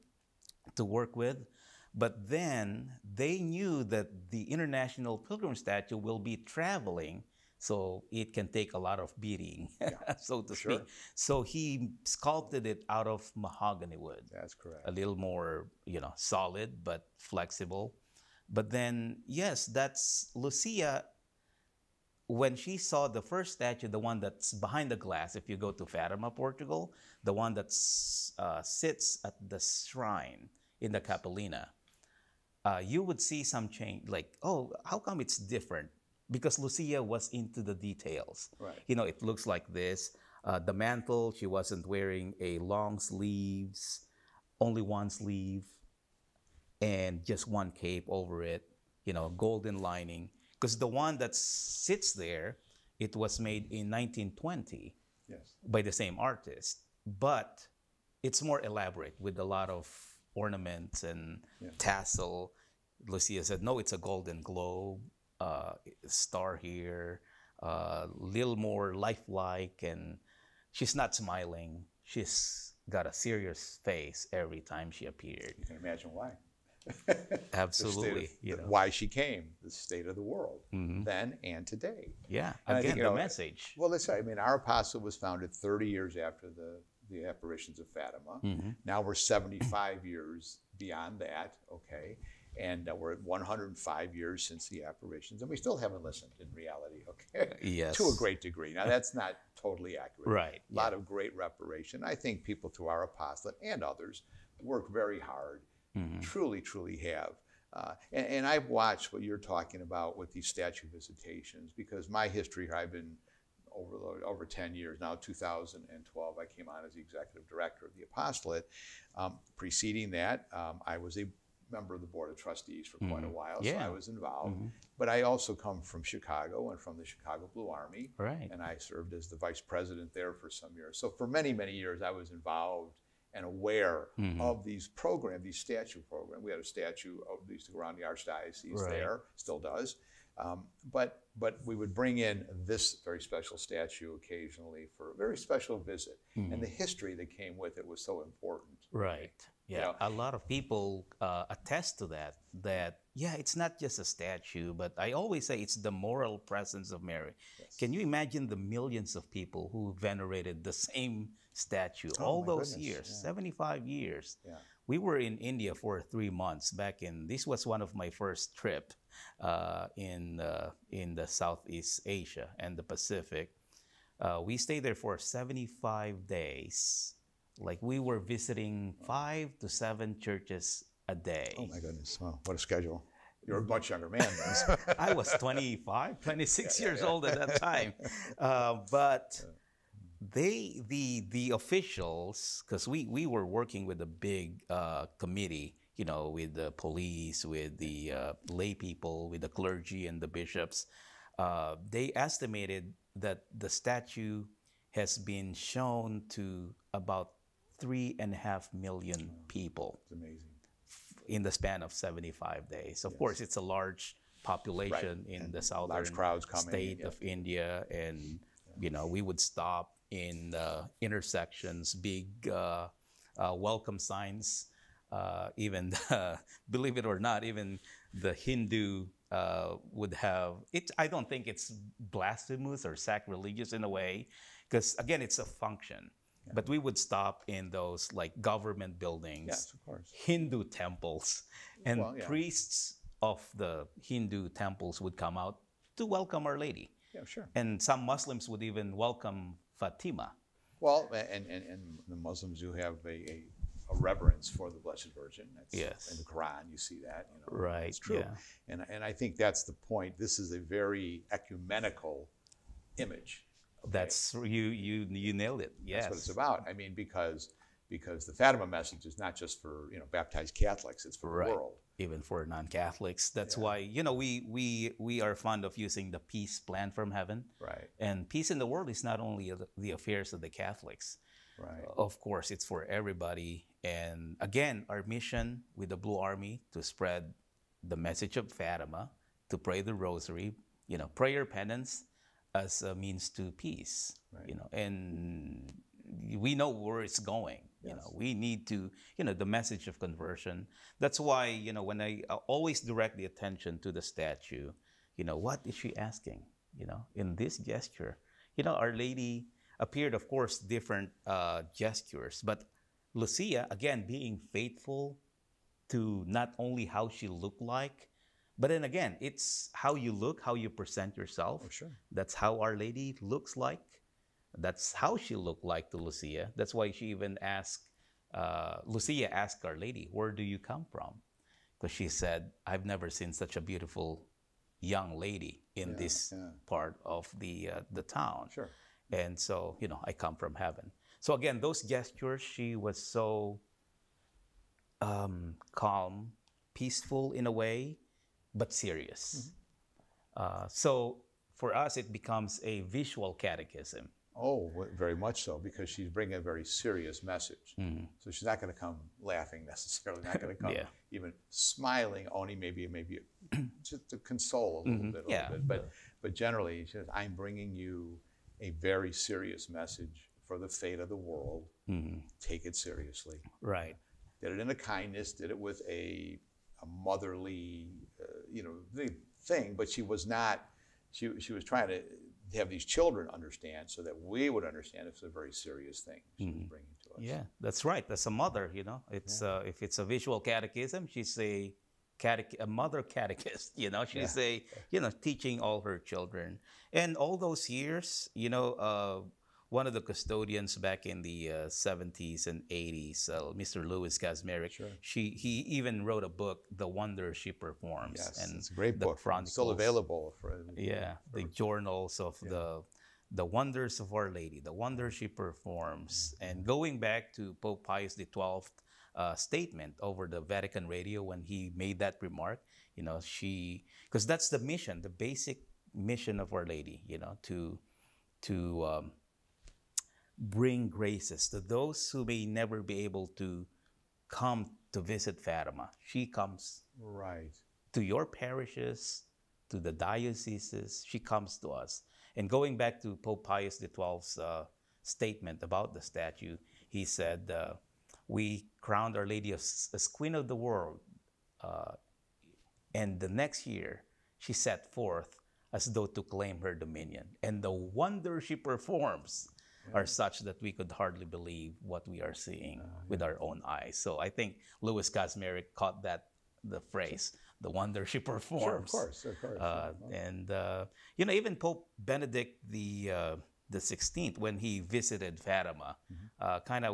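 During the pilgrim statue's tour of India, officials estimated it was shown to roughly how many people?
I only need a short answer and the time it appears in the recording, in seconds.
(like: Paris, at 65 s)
3.5 million, at 207 s.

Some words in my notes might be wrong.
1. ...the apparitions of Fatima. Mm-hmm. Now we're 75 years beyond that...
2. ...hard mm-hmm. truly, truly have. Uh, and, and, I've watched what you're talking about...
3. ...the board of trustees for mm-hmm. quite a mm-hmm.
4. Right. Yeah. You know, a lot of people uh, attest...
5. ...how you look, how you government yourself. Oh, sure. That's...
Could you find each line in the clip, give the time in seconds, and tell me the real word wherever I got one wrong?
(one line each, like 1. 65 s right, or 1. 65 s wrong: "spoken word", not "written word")
1. 87 s right
2. 105 s right
3. 121 s right
4. 148 s right
5. 319 s wrong: "present", not "government".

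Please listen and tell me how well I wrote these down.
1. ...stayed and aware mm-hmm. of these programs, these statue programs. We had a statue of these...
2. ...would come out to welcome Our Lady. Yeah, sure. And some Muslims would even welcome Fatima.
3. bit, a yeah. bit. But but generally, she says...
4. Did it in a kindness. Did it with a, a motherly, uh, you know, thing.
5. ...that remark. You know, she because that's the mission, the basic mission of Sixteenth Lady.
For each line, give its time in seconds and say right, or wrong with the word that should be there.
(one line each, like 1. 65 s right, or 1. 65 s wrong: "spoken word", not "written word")
1. 132 s wrong: "involved", not "stayed"
2. 245 s right
3. 365 s right
4. 374 s right
5. 421 s wrong: "Our", not "Sixteenth".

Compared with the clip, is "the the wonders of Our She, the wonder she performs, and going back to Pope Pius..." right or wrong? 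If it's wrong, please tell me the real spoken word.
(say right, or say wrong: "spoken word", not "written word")
wrong: "Lady", not "She".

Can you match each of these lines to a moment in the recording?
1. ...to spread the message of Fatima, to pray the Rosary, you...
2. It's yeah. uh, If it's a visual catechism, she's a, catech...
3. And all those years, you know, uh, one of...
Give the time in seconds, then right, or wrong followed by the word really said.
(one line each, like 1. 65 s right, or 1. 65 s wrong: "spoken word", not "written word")
1. 286 s right
2. 389 s right
3. 396 s right.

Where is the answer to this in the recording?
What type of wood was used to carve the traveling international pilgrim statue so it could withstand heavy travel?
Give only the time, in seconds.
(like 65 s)
13 s.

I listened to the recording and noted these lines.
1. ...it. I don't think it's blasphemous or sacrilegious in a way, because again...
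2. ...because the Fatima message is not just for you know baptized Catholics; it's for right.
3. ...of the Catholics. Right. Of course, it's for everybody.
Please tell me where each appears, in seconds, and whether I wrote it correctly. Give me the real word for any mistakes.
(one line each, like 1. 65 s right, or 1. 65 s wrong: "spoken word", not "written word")
1. 230 s right
2. 267 s right
3. 280 s right.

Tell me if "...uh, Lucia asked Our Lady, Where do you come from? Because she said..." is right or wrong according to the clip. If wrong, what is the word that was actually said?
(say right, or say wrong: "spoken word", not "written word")
right.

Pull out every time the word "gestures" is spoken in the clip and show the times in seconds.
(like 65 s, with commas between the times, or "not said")
307 s, 311 s, 341 s.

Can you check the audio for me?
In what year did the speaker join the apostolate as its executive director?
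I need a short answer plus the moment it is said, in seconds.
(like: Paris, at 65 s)
2012, at 115 s.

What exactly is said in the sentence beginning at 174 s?
Uh, we stayed there for 75 days.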